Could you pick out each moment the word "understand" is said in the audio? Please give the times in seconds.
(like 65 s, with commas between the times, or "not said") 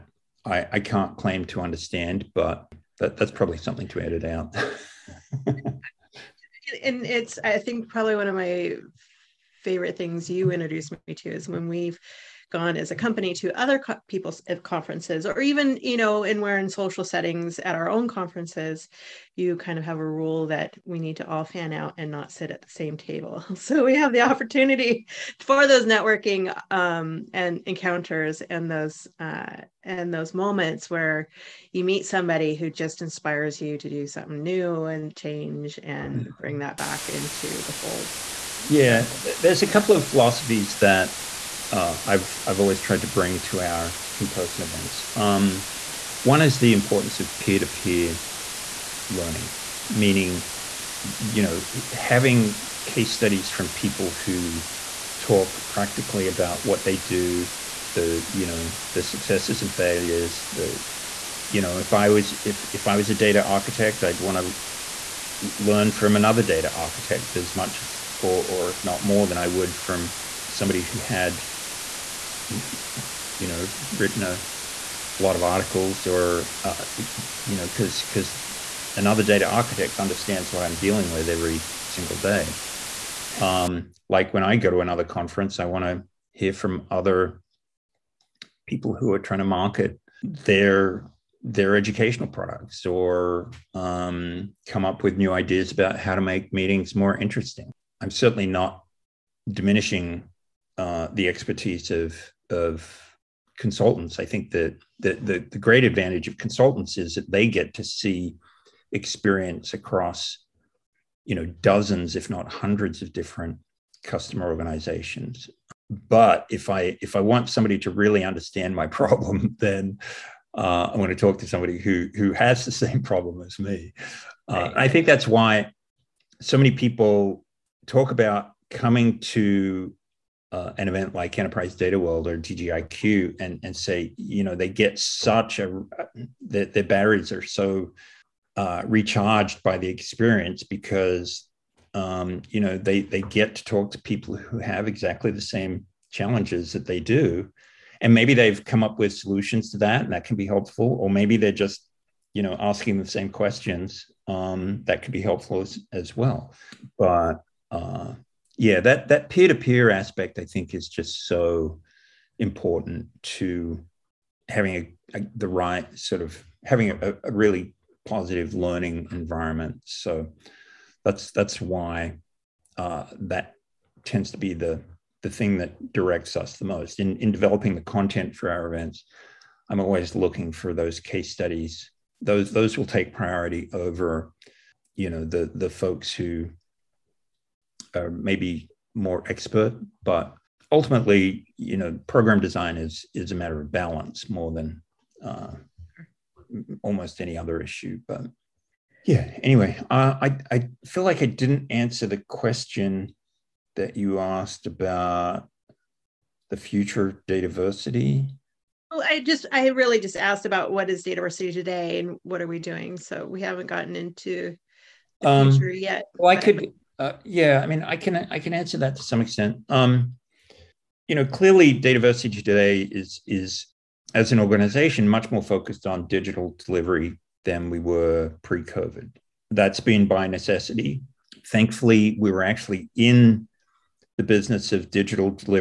1 s, 79 s, 118 s.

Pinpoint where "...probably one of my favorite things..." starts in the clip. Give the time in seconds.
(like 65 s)
7 s.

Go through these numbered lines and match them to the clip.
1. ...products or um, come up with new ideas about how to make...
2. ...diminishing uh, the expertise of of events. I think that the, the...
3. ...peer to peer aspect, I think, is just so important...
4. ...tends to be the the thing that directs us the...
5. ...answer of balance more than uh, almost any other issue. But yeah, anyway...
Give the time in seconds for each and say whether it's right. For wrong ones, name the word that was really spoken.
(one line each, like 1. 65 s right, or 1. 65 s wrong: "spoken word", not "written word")
1. 92 s right
2. 99 s wrong: "consultants", not "events"
3. 159 s right
4. 174 s right
5. 193 s wrong: "matter", not "answer".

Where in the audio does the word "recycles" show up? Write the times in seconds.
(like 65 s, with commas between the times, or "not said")
not said.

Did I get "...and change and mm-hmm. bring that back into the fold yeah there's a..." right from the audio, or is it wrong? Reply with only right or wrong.
right.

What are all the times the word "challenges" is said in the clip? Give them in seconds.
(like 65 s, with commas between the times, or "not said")
146 s.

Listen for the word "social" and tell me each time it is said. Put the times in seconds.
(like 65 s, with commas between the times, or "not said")
16 s.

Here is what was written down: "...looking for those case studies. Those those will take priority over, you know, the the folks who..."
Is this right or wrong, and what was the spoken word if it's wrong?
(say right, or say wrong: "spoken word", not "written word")
right.